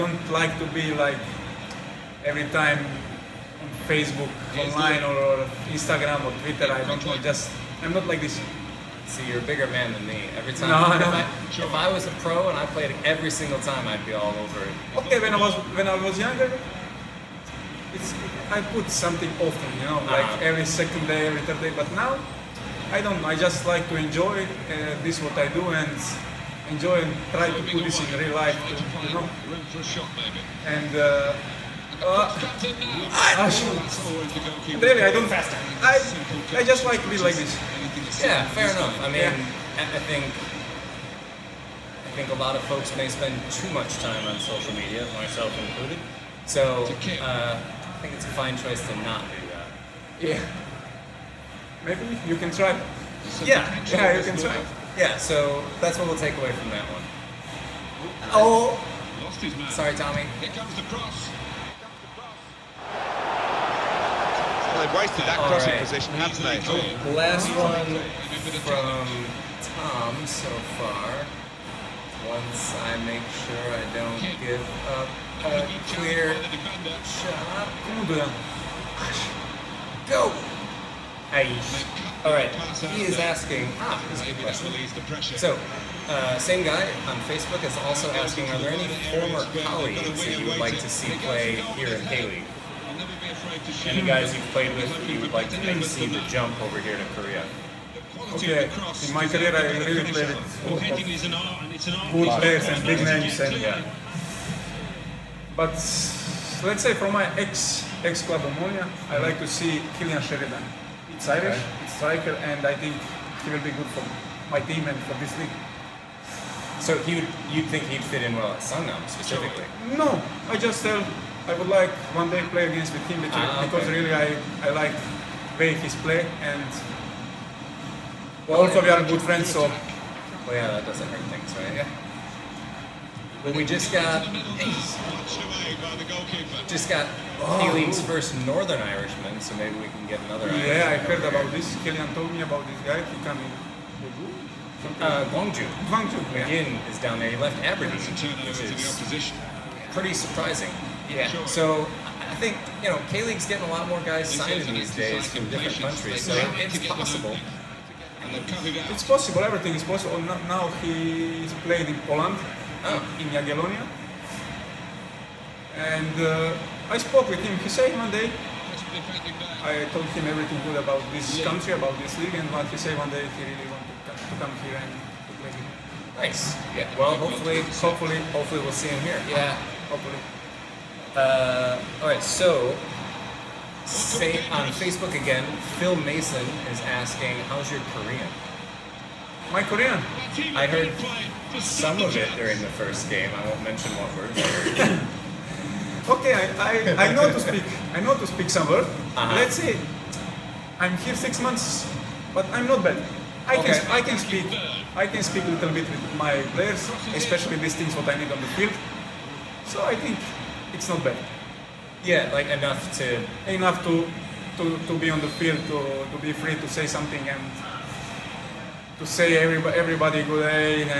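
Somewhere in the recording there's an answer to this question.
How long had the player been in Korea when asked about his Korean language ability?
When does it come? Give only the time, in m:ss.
3:21.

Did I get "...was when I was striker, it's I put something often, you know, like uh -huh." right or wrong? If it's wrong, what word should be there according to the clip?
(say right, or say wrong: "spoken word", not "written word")
wrong: "younger", not "striker".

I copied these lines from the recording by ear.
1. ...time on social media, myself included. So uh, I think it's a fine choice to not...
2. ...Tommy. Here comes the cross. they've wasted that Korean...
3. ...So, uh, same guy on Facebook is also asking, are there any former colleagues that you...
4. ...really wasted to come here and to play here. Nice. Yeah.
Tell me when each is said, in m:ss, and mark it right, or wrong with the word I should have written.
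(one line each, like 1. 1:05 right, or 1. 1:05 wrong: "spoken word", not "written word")
1. 0:44 right
2. 0:59 wrong: "All", not "Korean"
3. 1:25 right
4. 2:53 wrong: "wanted", not "wasted".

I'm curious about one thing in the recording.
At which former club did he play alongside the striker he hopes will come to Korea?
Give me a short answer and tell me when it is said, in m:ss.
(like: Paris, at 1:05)
Omonia, at 1:48.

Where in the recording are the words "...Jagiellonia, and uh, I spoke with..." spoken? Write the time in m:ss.
2:43.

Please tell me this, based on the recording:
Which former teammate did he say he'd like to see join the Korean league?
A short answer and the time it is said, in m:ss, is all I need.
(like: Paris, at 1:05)
Cillian Sheridan, at 1:49.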